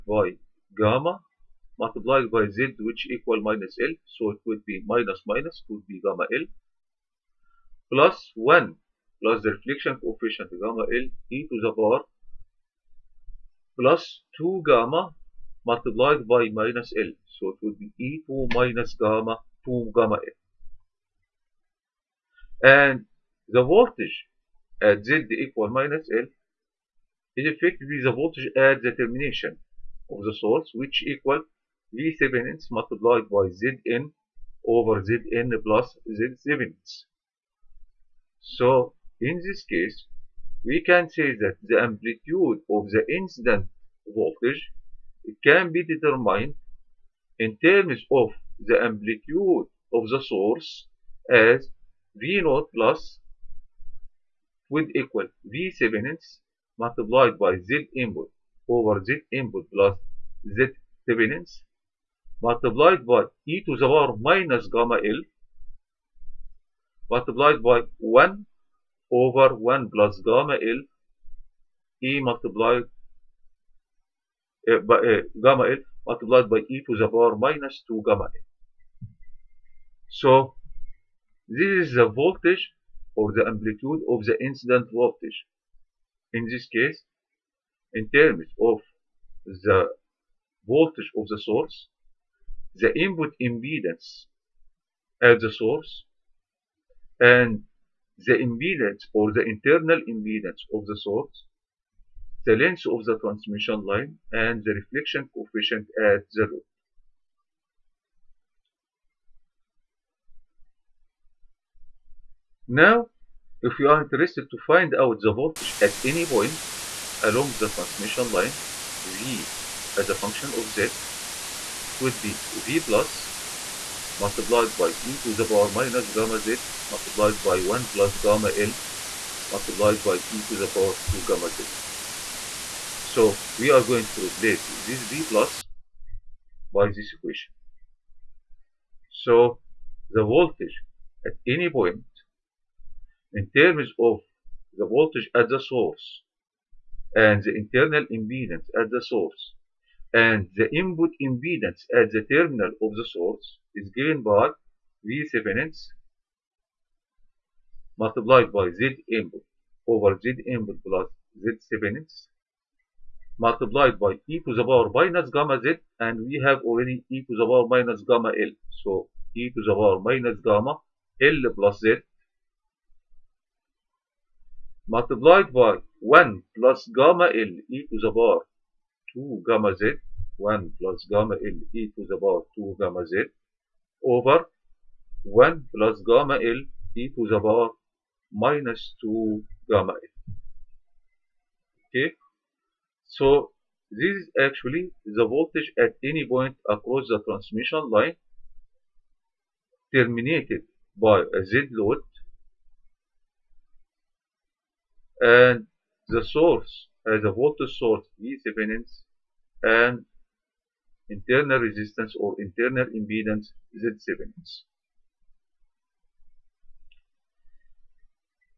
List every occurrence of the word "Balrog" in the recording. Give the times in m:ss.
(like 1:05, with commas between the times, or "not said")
not said.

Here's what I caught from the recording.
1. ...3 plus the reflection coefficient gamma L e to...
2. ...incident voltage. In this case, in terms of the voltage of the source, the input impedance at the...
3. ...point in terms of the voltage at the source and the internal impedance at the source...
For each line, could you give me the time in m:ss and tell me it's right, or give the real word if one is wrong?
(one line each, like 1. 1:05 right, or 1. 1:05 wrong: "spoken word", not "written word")
1. 0:08 wrong: "1", not "3"
2. 1:24 right
3. 2:21 right.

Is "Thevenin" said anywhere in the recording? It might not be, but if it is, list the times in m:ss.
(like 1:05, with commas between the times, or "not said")
1:01, 2:35, 2:41, 3:28, 3:34.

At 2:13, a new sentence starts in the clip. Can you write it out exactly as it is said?
So we are going to replace this V plus by this equation.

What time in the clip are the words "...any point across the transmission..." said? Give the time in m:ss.
3:16.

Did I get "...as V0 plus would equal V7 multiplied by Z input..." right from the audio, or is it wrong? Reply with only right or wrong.
right.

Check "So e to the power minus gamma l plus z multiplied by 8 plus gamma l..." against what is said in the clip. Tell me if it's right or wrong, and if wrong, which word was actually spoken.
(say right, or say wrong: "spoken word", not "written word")
wrong: "1", not "8".